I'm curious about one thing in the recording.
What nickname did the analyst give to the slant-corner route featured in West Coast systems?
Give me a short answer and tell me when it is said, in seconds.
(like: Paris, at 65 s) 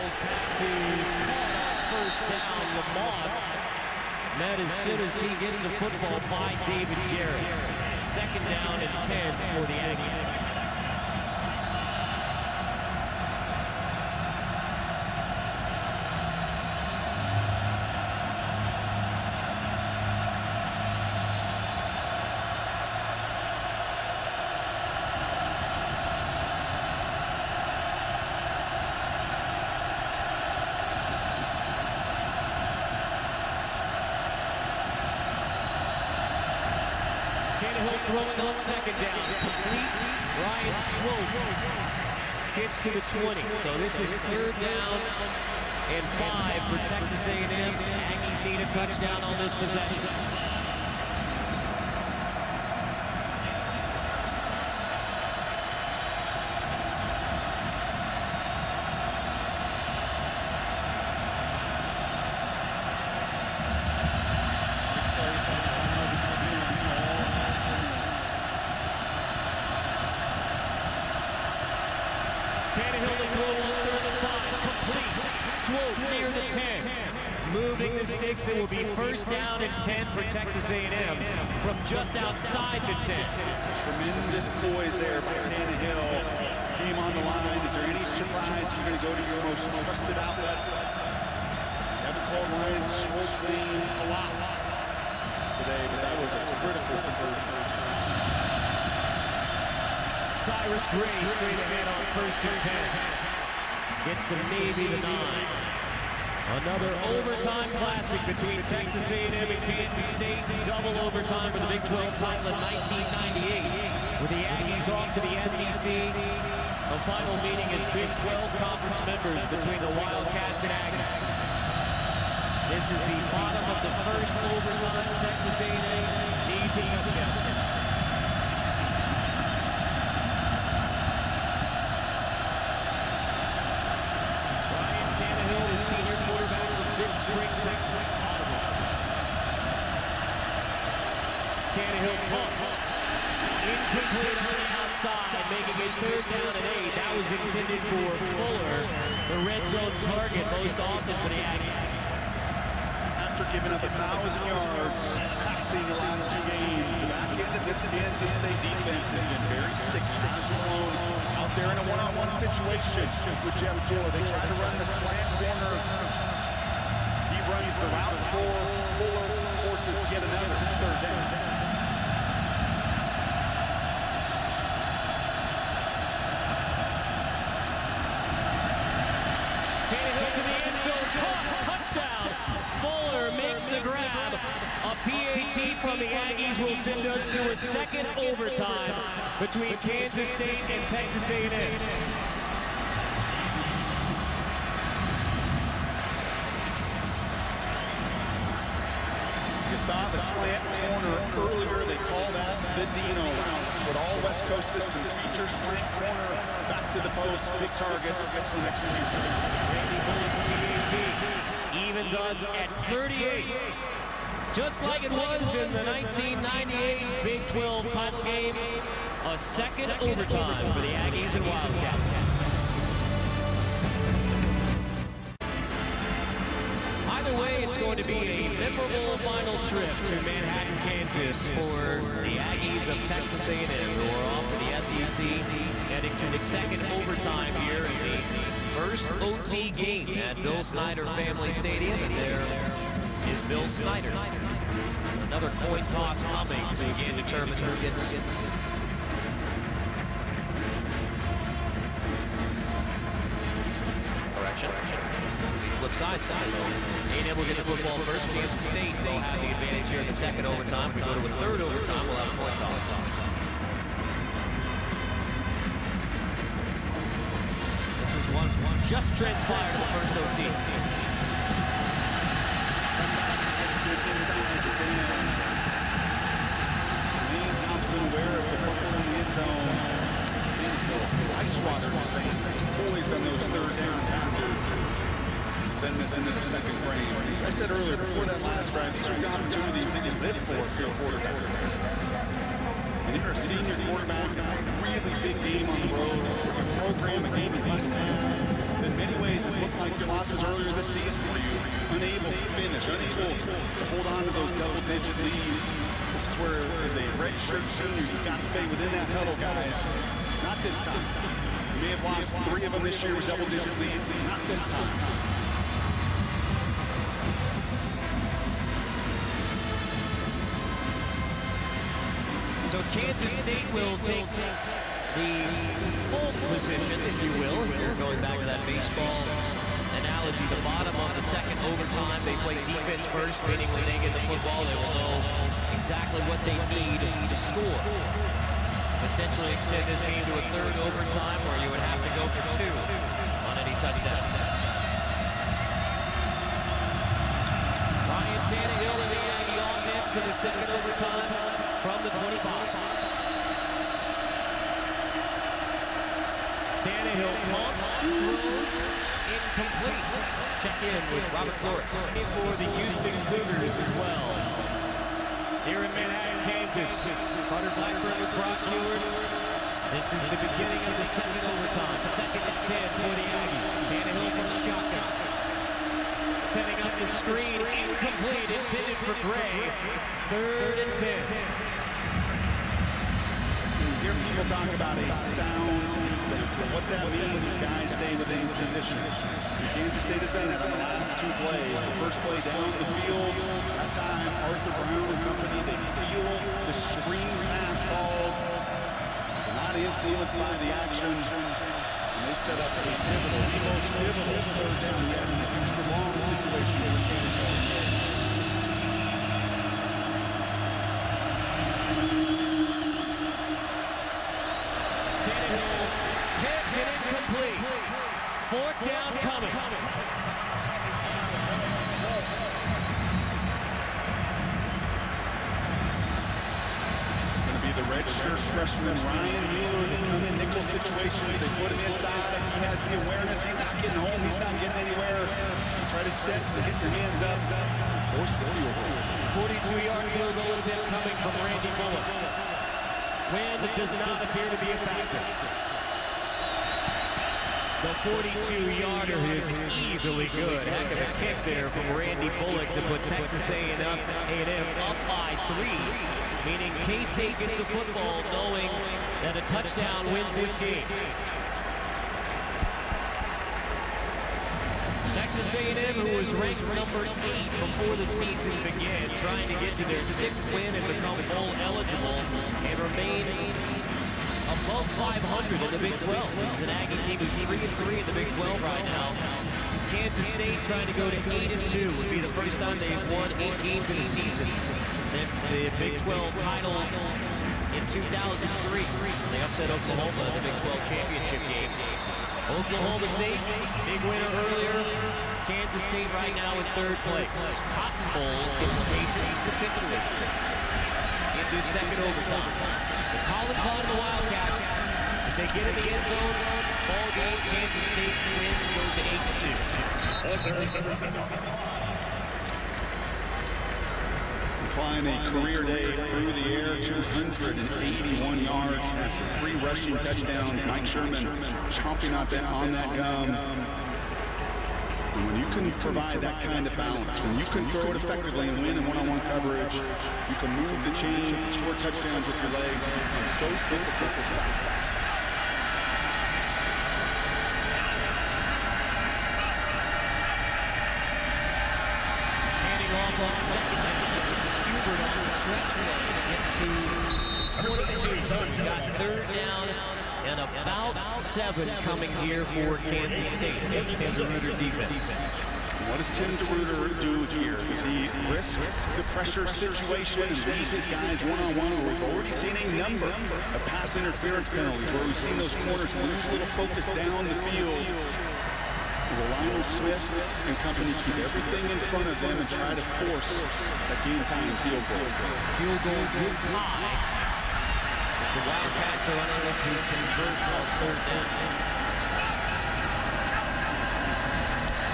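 Dino route, at 202 s.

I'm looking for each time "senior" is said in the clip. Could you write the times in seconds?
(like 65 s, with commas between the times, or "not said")
293 s, 307 s.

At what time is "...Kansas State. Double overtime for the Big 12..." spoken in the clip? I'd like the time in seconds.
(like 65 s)
109 s.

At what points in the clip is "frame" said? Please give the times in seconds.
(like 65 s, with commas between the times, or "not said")
286 s.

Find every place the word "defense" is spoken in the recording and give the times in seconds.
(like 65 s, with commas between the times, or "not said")
158 s, 332 s, 385 s, 554 s.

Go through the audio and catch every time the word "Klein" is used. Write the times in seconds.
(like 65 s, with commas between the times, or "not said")
503 s.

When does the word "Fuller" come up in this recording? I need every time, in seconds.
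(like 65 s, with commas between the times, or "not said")
148 s, 168 s, 182 s.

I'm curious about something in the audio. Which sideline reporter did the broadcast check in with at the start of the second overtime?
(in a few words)
Robert Flores.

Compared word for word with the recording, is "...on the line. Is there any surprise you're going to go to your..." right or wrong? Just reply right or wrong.
right.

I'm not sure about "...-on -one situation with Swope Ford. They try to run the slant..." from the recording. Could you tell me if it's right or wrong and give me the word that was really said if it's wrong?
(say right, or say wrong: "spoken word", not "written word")
wrong: "Jeff", not "Swope".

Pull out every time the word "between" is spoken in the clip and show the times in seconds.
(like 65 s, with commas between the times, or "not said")
108 s, 119 s, 189 s.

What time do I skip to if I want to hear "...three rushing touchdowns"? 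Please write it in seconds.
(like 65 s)
519 s.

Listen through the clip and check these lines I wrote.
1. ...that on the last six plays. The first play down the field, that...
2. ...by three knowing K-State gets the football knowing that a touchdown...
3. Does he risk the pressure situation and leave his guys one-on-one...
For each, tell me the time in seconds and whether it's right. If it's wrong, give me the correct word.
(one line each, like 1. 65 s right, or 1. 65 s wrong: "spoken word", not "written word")
1. 390 s wrong: "two", not "six"
2. 455 s wrong: "meaning", not "knowing"
3. 557 s right.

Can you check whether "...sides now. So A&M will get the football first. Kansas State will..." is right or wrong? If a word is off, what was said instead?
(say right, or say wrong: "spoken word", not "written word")
right.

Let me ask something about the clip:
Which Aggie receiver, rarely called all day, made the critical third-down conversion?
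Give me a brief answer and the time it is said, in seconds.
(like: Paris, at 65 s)
Ryan Swope, at 92 s.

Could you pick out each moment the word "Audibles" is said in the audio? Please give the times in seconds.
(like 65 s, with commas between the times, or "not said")
138 s.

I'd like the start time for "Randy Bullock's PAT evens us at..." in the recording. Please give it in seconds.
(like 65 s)
209 s.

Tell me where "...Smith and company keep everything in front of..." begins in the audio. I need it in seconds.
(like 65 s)
569 s.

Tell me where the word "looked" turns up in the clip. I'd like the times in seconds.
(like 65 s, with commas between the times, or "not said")
299 s.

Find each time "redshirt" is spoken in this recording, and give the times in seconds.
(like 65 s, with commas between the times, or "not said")
307 s, 428 s.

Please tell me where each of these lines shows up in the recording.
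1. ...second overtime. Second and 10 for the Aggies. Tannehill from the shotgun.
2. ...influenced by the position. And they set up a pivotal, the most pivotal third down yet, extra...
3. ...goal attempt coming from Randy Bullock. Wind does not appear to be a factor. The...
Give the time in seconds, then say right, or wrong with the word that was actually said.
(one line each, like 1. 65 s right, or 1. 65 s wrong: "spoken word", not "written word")
1. 371 s right
2. 399 s wrong: "action", not "position"
3. 440 s right.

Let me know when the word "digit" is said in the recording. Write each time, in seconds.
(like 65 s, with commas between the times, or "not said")
304 s, 313 s.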